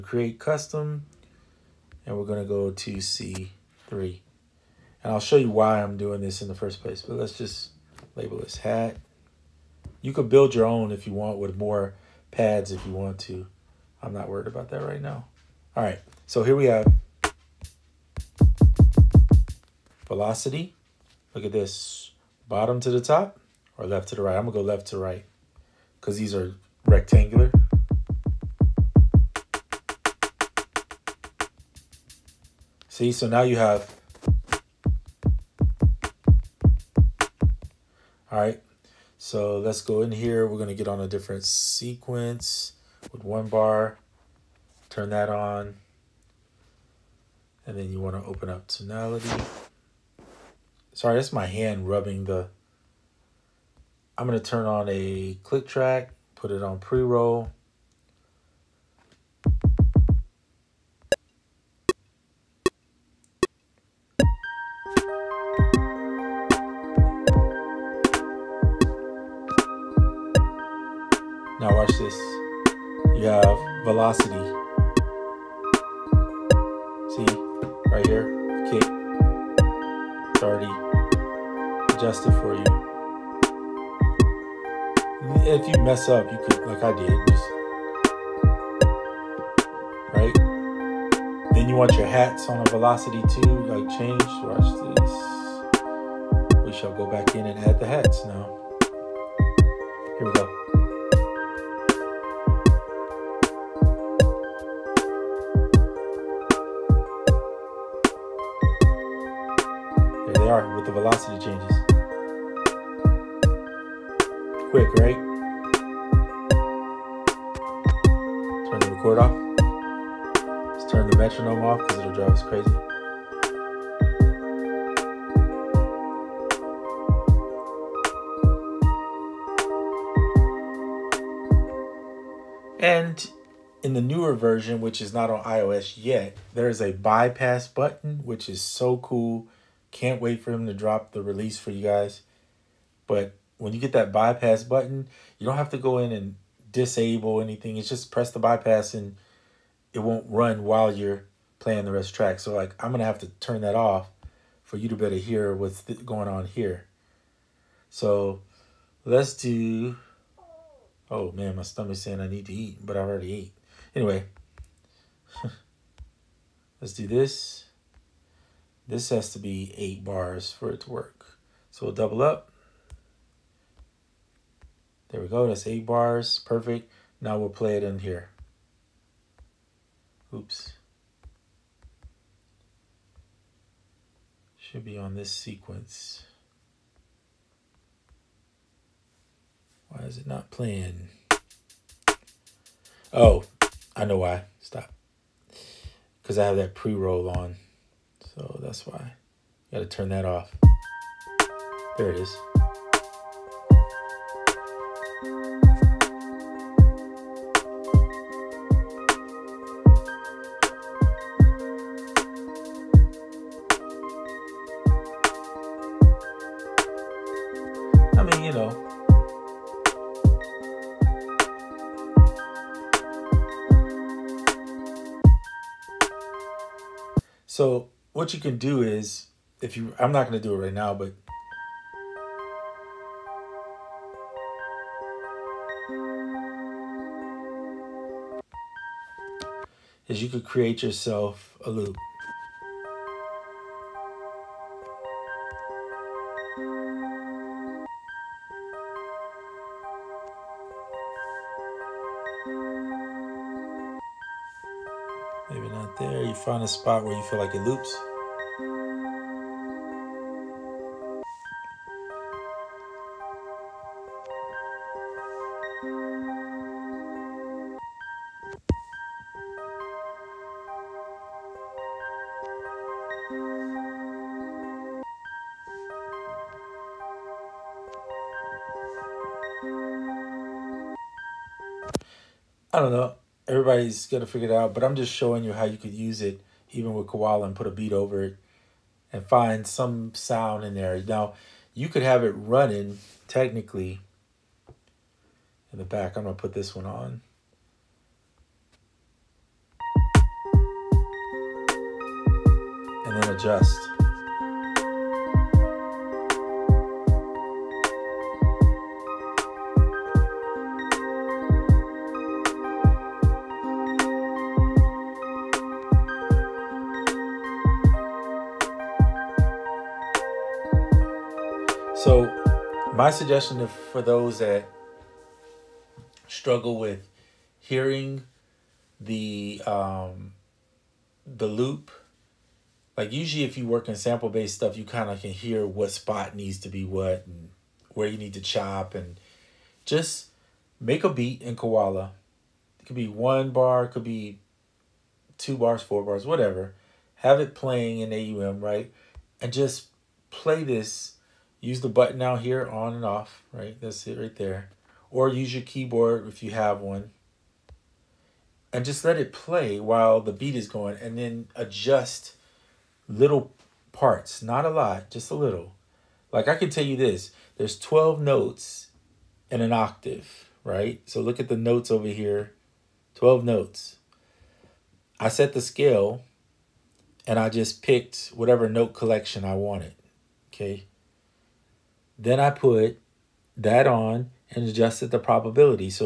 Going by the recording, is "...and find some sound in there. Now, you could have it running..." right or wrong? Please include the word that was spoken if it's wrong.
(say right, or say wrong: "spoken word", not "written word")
right.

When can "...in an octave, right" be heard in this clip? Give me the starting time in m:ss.
6:09.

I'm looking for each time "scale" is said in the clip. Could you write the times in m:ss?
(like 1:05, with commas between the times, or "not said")
6:15.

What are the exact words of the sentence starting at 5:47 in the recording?
Have it playing in AUM, right?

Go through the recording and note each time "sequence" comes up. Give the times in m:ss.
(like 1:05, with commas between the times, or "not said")
0:41, 3:05.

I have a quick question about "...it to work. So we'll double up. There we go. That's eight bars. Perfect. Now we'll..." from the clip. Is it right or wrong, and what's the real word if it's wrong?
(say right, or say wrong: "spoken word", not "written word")
right.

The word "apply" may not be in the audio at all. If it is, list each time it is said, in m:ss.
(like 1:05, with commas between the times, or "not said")
not said.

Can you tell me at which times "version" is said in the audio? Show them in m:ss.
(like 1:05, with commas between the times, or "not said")
2:14.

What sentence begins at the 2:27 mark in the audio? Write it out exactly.
It's just press the bypass and it won't run while you're playing the rest track.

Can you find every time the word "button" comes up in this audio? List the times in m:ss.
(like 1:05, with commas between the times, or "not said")
2:17, 2:24, 5:51.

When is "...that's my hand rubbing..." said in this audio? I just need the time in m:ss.
0:51.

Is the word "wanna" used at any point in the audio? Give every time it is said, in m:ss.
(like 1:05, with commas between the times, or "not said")
0:48.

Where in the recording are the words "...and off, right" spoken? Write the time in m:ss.
5:52.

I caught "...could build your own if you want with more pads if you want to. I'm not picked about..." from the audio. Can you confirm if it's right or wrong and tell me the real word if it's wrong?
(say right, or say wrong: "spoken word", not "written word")
wrong: "worried", not "picked".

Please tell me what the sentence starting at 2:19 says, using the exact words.
Can't wait for him to drop the release for you guys.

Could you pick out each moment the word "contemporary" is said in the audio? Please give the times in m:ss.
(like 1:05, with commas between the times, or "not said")
not said.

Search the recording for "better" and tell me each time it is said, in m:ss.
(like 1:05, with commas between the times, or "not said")
2:34.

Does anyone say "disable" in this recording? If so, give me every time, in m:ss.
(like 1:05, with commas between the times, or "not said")
2:26.